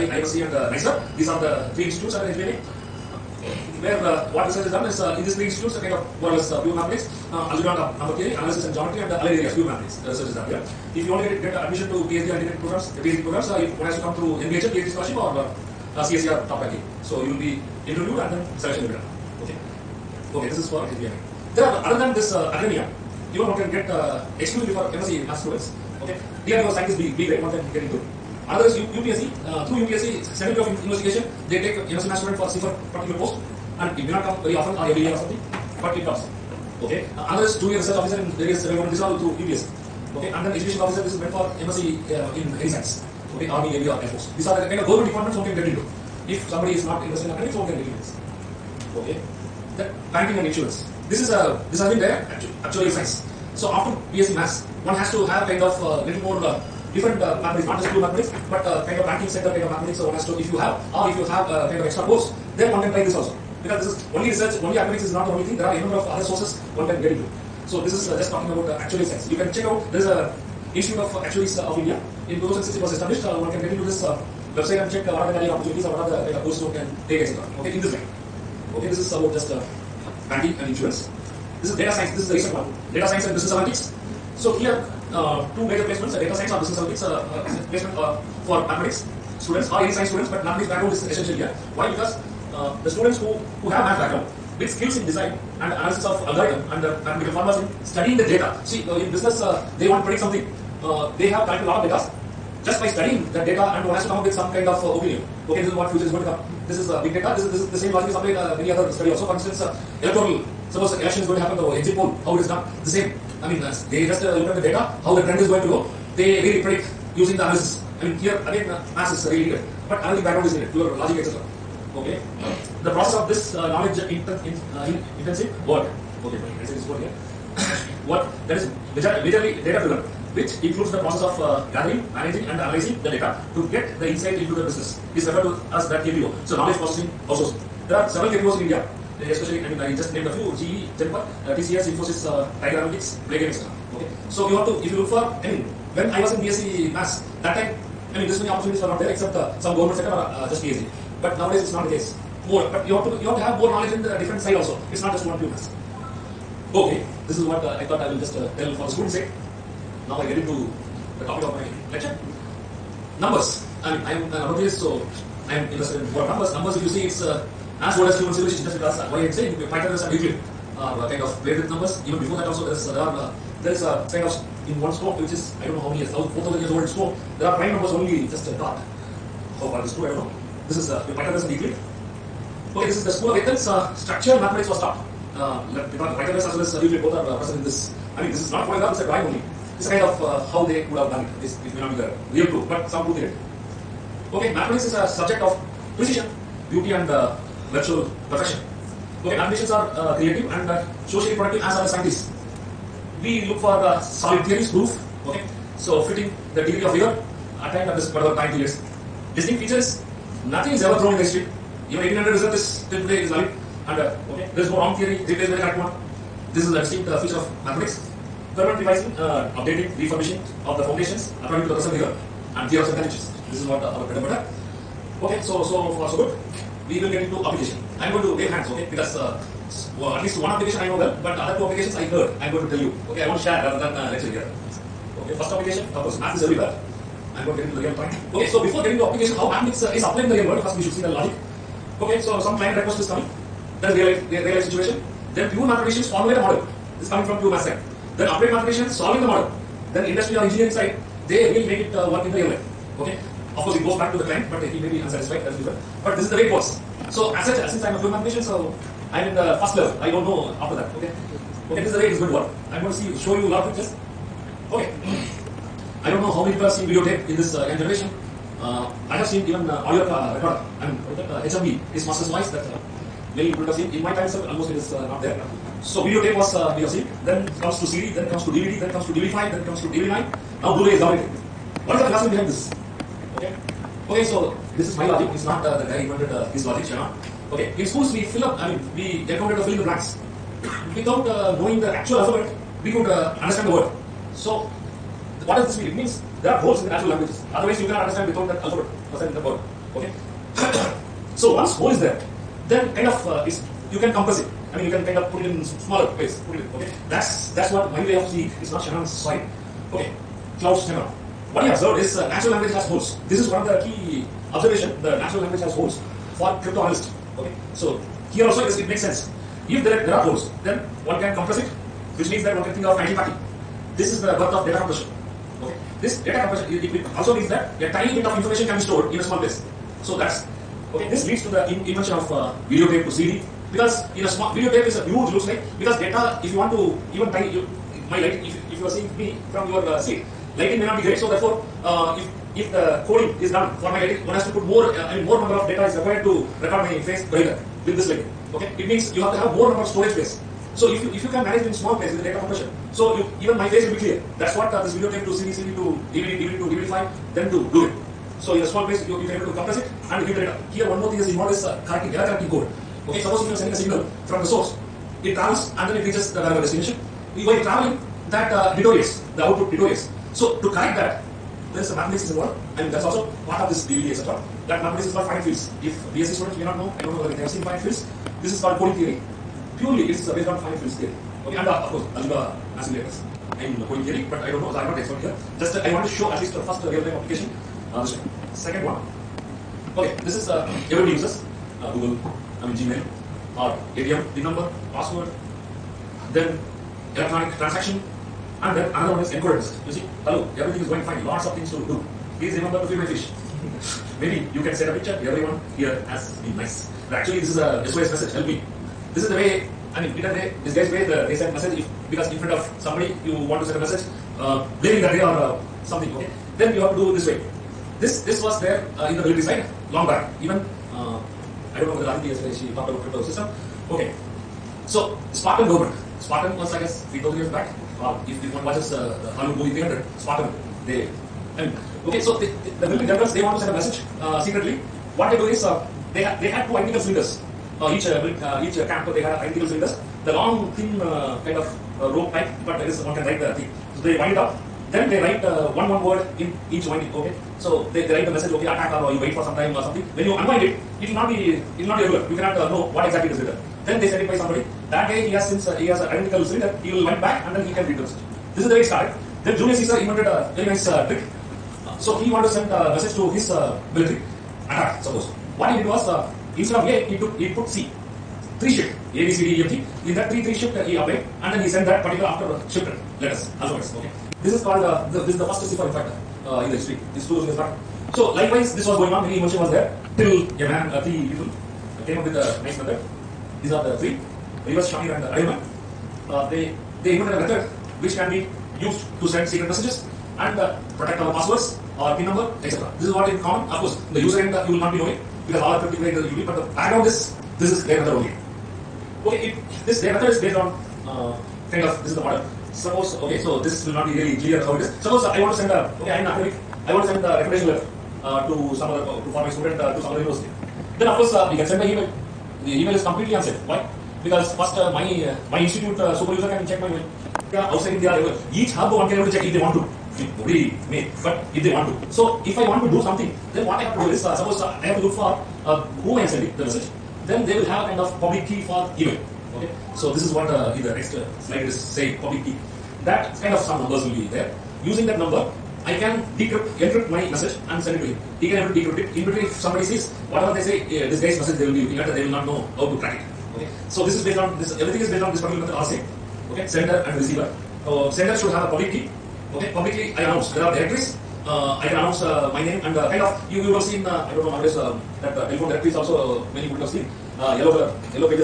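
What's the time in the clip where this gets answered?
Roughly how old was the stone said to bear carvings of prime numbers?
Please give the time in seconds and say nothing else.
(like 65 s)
176 s.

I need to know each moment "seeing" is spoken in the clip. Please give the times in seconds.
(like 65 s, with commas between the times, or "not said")
308 s, 338 s.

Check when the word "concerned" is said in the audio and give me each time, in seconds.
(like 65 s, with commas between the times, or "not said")
not said.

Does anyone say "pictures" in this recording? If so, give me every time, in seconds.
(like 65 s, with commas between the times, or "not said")
263 s, 404 s.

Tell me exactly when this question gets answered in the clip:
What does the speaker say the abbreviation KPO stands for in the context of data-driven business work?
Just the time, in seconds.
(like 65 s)
136 s.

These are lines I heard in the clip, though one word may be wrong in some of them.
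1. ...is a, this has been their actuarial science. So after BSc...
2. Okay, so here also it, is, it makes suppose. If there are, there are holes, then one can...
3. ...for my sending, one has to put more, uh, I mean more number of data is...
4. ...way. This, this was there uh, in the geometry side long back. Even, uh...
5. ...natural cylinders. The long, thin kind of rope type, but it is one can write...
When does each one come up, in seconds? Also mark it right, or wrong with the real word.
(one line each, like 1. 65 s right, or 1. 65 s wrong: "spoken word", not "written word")
1. 51 s right
2. 317 s wrong: "sense", not "suppose"
3. 343 s wrong: "lighting", not "sending"
4. 417 s wrong: "military", not "geometry"
5. 439 s wrong: "identical", not "natural".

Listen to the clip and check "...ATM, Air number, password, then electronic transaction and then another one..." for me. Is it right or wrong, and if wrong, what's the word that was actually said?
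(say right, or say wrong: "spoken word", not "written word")
wrong: "PIN", not "Air".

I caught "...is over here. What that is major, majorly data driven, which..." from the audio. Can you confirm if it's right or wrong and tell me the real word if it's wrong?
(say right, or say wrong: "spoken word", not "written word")
right.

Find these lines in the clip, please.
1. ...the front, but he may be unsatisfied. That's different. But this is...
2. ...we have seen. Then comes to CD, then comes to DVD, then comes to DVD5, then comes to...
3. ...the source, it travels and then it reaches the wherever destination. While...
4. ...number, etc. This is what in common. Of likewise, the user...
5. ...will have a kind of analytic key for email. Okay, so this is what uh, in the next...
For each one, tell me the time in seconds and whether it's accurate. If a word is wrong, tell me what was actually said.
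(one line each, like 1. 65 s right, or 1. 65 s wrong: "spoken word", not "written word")
1. 254 s wrong: "client", not "front"
2. 276 s right
3. 364 s right
4. 492 s wrong: "course", not "likewise"
5. 527 s wrong: "public", not "analytic".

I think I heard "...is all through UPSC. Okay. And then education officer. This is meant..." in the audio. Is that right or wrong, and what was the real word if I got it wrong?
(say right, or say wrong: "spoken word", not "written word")
right.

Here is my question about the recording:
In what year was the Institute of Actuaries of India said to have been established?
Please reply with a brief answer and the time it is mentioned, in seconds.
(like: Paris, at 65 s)
2006, at 72 s.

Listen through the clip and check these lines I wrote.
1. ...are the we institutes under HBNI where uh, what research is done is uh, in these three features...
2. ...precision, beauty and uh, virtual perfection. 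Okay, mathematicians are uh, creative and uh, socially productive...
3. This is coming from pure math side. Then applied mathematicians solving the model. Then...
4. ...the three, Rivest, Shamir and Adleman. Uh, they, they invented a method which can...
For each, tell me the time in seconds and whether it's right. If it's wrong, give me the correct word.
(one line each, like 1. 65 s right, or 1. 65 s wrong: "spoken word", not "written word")
1. 1 s wrong: "institutes", not "features"
2. 195 s right
3. 247 s right
4. 483 s right.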